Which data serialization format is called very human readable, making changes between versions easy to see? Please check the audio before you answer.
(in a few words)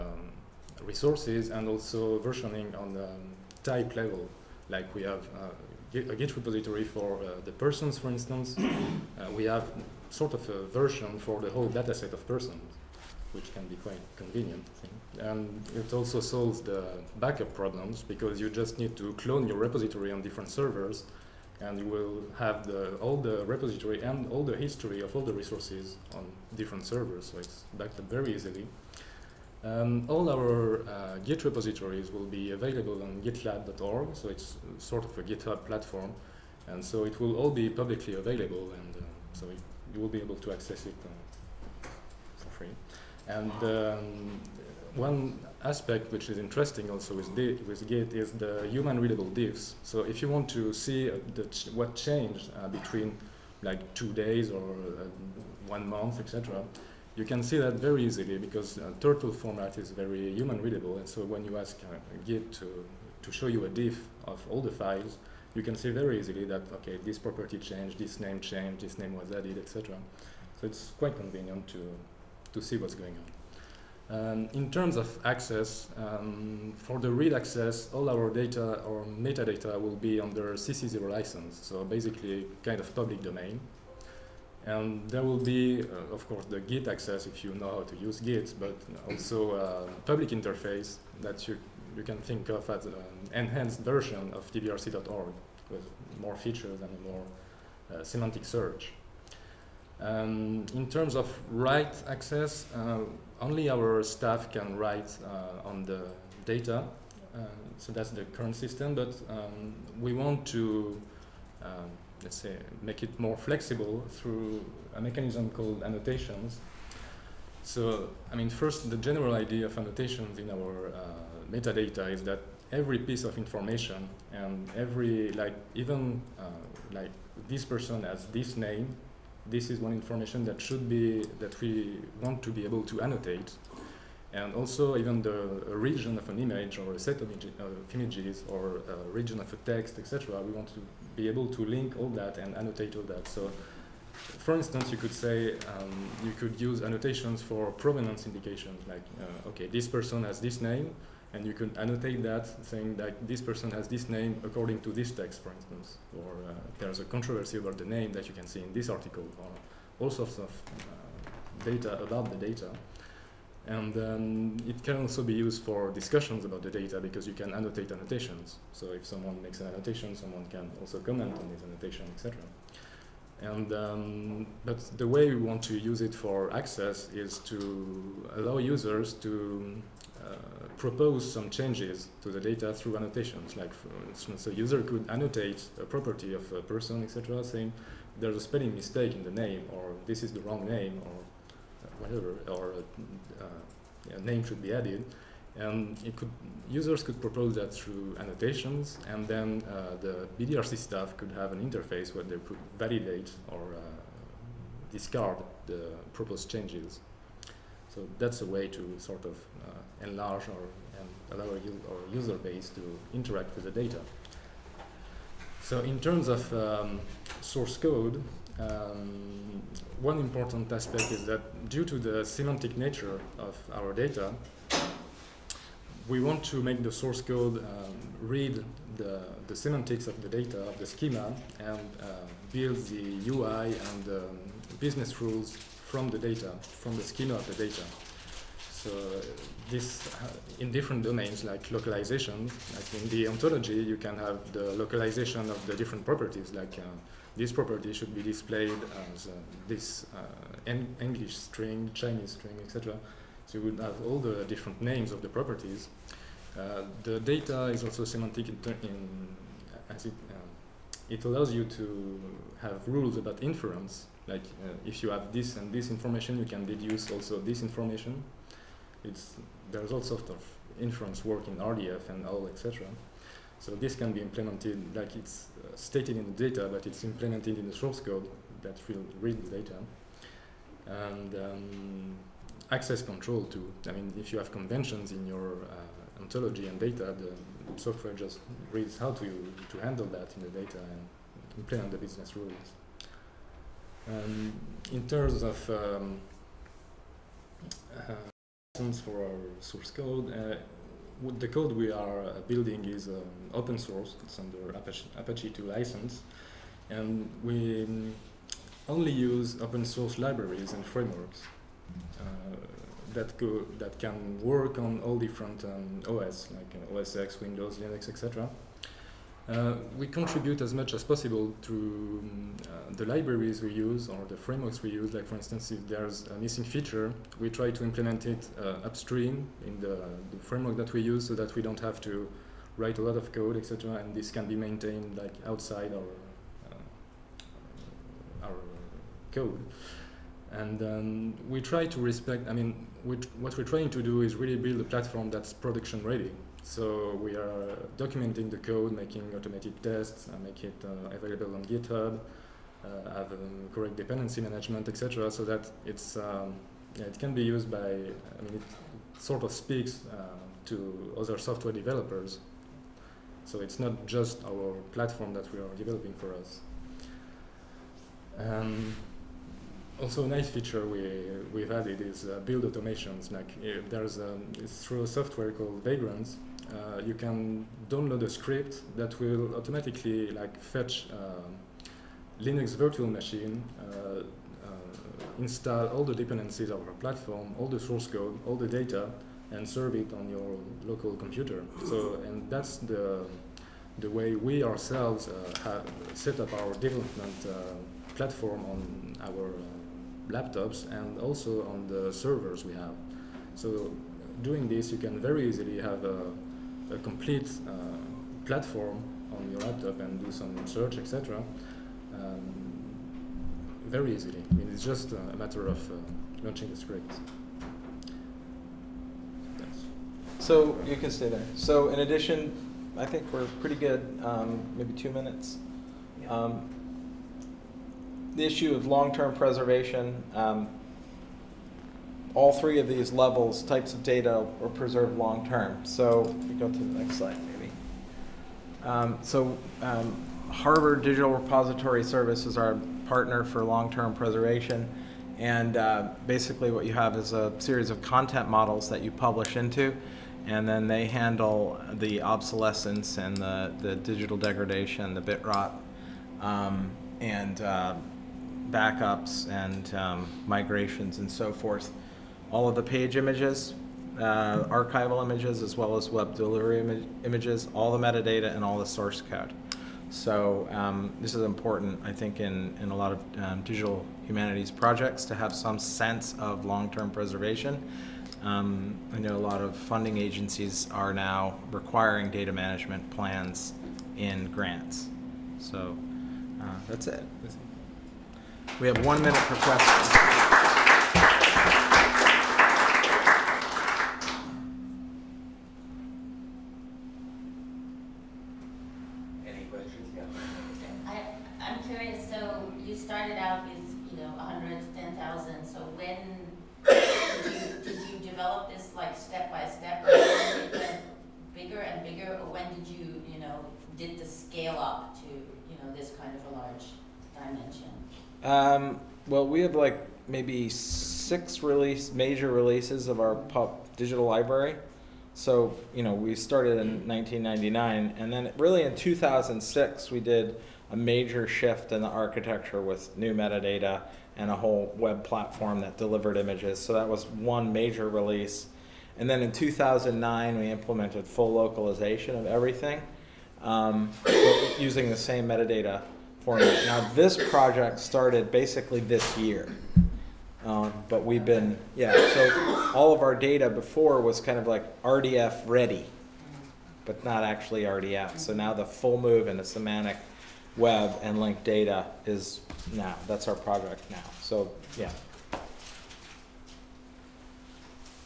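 Turtle.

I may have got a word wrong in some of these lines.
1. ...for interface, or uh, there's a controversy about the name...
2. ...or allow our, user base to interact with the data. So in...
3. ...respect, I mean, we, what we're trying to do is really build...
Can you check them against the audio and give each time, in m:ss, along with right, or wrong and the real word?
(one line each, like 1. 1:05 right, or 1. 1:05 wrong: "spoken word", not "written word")
1. 2:35 wrong: "instance", not "interface"
2. 3:30 right
3. 5:41 right.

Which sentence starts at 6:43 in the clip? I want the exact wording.
So doing this, you can very easily have a, a complete uh, platform on your laptop and do some search, etc.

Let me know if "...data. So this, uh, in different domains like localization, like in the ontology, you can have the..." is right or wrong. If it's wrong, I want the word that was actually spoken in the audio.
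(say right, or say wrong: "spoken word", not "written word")
right.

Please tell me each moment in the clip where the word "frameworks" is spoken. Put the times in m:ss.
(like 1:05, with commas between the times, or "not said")
5:10, 5:24, 5:30.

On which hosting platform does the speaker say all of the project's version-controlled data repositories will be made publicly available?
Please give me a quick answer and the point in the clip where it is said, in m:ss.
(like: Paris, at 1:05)
gitlab.org, at 0:33.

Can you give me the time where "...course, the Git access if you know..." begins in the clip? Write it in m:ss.
1:26.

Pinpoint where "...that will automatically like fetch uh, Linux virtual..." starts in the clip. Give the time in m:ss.
6:18.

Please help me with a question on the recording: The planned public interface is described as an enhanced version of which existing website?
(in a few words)
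tbrc.org.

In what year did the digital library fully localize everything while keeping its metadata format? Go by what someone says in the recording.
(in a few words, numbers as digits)
2009.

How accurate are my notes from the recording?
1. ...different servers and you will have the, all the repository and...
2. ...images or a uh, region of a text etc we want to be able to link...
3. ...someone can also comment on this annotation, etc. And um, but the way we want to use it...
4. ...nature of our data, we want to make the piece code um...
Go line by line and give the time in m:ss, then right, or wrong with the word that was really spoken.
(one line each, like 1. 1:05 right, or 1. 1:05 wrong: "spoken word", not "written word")
1. 0:20 right
2. 2:17 right
3. 2:50 right
4. 3:42 wrong: "source", not "piece".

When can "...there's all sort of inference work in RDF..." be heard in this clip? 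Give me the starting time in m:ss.
4:29.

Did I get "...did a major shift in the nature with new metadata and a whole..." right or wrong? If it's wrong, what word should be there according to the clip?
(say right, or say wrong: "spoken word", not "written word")
wrong: "architecture", not "nature".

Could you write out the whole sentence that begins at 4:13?
So you would have all the different names of the properties.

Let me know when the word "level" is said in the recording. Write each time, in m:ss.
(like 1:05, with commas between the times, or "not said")
0:03, 7:13.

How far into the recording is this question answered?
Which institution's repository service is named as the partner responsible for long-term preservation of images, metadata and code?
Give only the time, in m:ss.
7:20.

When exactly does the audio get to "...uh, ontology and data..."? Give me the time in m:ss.
4:45.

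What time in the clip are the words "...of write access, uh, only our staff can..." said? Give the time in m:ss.
1:41.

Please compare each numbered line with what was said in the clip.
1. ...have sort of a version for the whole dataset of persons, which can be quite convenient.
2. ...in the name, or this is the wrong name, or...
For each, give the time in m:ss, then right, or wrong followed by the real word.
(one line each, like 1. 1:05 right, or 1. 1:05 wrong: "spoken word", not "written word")
1. 0:09 right
2. 3:09 right.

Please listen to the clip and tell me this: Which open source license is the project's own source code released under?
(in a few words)
Apache 2.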